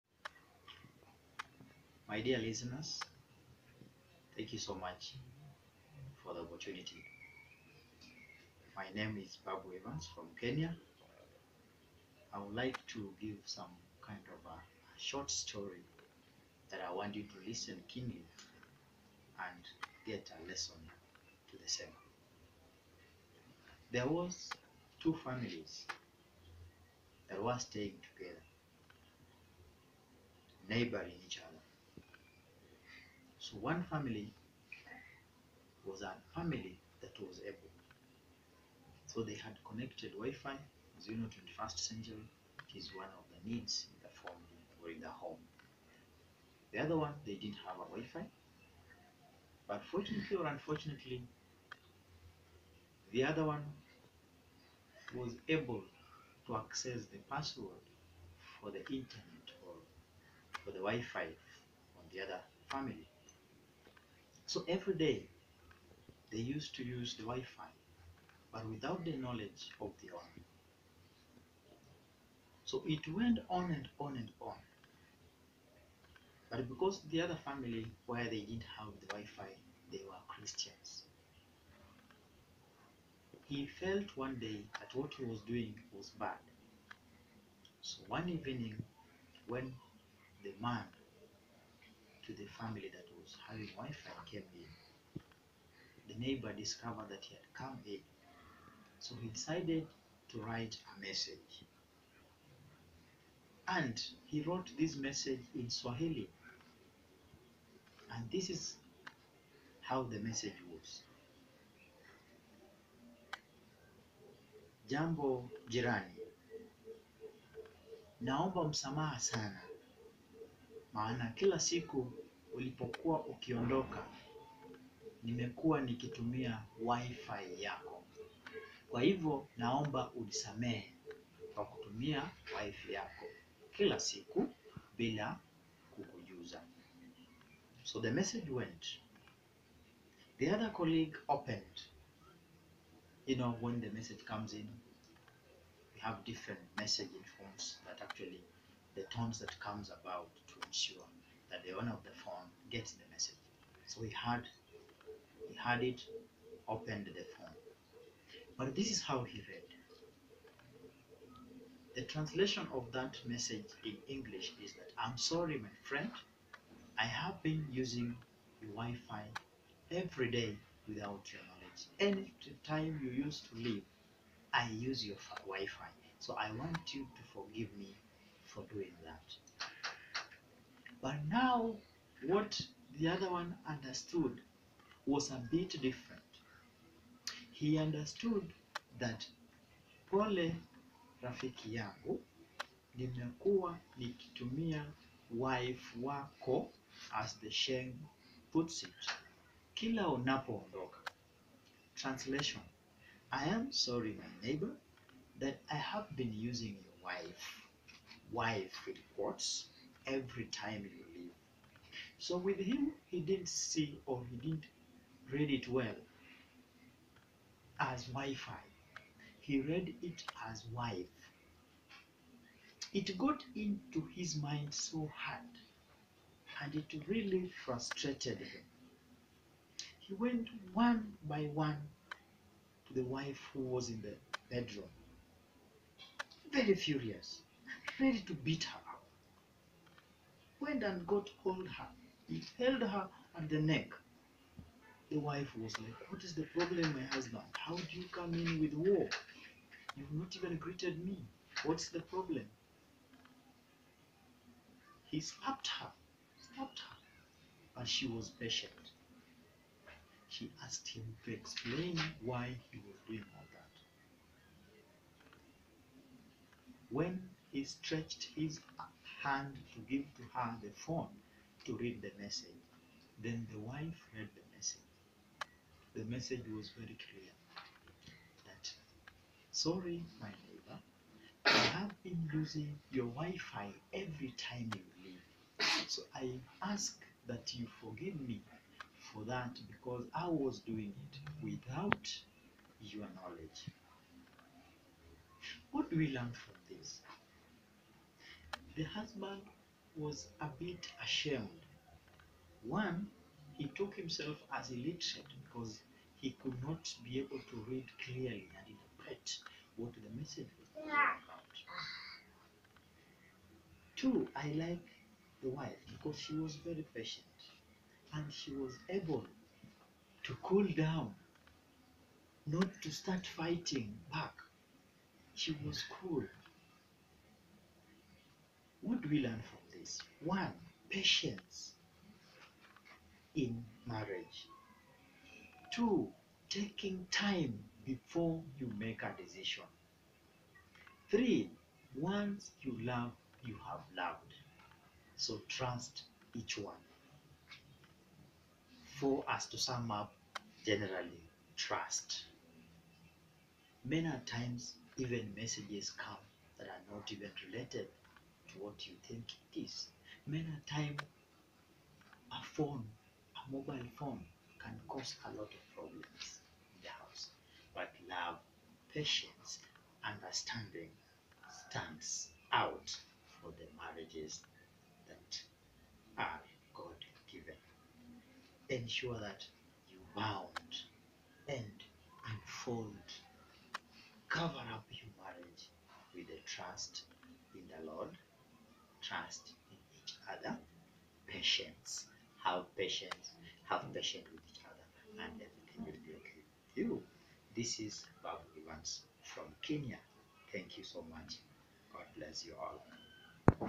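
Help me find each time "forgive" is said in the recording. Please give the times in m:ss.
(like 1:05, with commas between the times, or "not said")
2:57, 4:47.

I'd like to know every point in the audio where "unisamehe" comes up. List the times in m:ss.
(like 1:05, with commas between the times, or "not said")
2:10.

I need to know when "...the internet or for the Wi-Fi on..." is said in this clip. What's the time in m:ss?
0:58.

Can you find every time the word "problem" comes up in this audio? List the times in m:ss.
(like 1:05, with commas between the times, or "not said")
4:06, 4:11, 6:05.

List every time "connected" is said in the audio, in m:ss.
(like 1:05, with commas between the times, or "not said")
0:39.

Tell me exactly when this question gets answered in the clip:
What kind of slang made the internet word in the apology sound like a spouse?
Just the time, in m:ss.
3:17.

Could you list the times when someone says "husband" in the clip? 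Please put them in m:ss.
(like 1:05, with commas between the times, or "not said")
4:07, 4:58.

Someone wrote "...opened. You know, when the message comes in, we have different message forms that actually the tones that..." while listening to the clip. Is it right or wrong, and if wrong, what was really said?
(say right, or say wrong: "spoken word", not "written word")
right.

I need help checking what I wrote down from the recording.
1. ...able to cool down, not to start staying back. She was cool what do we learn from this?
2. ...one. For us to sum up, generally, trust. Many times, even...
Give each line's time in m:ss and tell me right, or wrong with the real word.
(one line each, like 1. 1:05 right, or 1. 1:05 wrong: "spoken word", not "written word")
1. 5:18 wrong: "fighting", not "staying"
2. 5:46 right.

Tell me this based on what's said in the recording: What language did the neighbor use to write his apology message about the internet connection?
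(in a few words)
Swahili.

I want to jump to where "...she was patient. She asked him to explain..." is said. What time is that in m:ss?
4:17.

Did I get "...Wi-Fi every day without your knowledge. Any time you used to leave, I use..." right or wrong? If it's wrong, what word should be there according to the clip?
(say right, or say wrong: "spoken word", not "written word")
right.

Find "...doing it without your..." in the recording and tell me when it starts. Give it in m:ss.
4:50.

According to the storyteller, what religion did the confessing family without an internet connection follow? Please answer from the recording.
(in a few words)
Christians.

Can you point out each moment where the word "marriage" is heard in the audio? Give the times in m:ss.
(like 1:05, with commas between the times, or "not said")
5:33, 6:13, 6:25.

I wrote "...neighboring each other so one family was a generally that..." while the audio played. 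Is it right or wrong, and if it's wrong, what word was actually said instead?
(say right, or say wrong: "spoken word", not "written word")
wrong: "family", not "generally".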